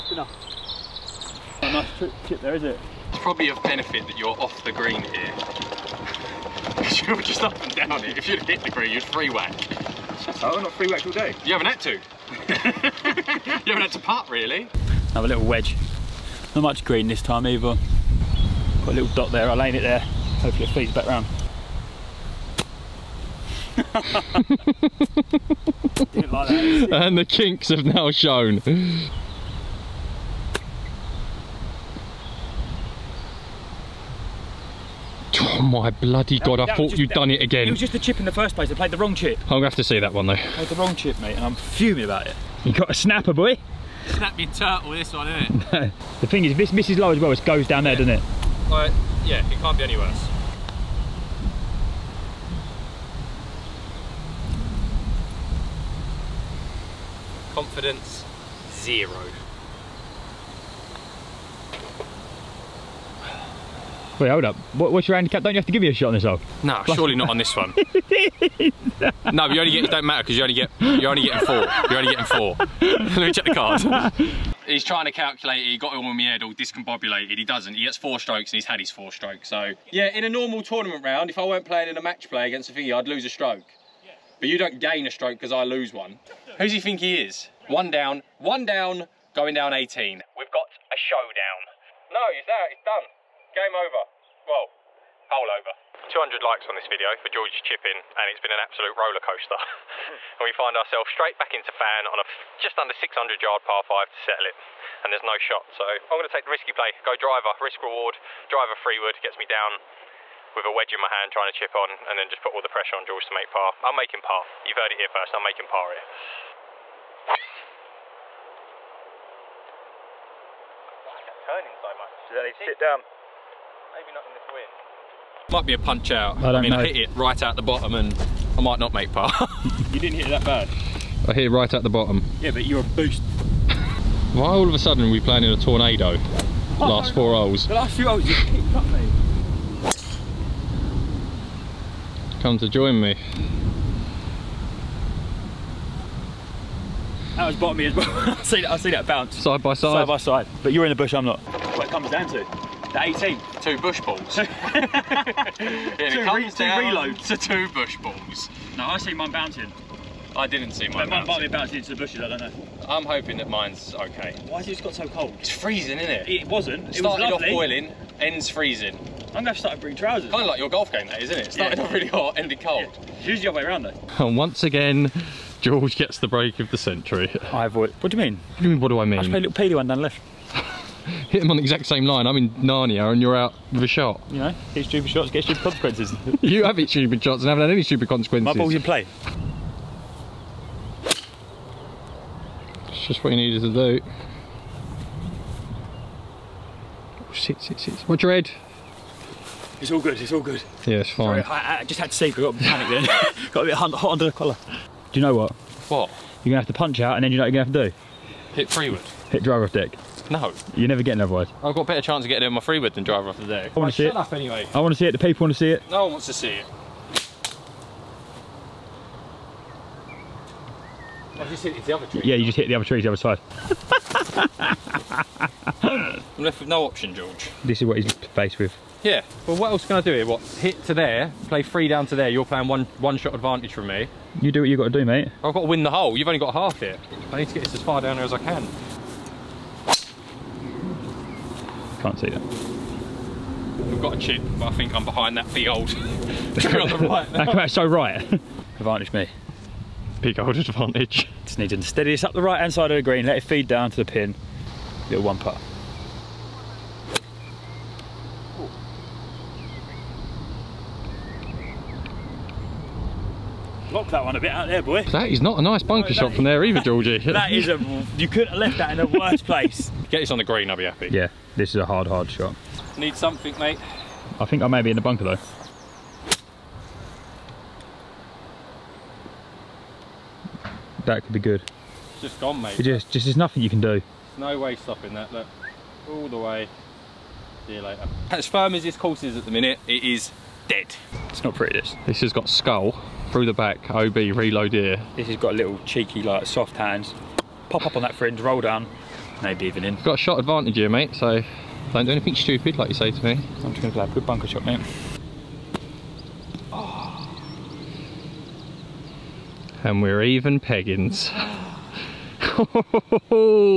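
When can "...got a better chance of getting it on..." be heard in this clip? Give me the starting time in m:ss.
3:31.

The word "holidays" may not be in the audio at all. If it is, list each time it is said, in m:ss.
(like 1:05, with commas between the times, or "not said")
not said.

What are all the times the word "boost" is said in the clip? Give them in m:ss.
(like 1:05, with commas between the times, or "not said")
2:12.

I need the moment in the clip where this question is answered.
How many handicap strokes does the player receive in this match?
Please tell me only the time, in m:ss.
1:17.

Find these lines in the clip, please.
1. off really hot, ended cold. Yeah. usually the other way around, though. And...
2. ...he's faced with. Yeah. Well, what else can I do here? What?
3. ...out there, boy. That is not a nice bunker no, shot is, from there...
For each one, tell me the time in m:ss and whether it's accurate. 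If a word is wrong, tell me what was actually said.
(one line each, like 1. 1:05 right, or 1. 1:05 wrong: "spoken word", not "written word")
1. 2:51 right
2. 3:47 right
3. 4:24 right.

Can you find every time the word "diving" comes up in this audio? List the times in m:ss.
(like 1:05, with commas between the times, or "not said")
4:59.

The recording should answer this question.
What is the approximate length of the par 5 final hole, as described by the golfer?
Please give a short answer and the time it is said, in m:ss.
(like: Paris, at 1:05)
just under 600 yards, at 1:42.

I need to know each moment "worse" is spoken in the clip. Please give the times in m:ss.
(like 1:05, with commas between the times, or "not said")
0:49, 4:29.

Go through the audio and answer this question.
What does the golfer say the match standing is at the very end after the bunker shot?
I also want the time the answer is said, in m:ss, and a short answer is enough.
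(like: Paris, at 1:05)
even, at 5:10.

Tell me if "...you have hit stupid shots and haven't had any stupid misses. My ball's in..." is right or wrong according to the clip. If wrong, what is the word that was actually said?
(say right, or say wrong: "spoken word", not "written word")
wrong: "consequences", not "misses".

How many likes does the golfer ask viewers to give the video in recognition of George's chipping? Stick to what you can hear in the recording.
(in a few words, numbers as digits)
200.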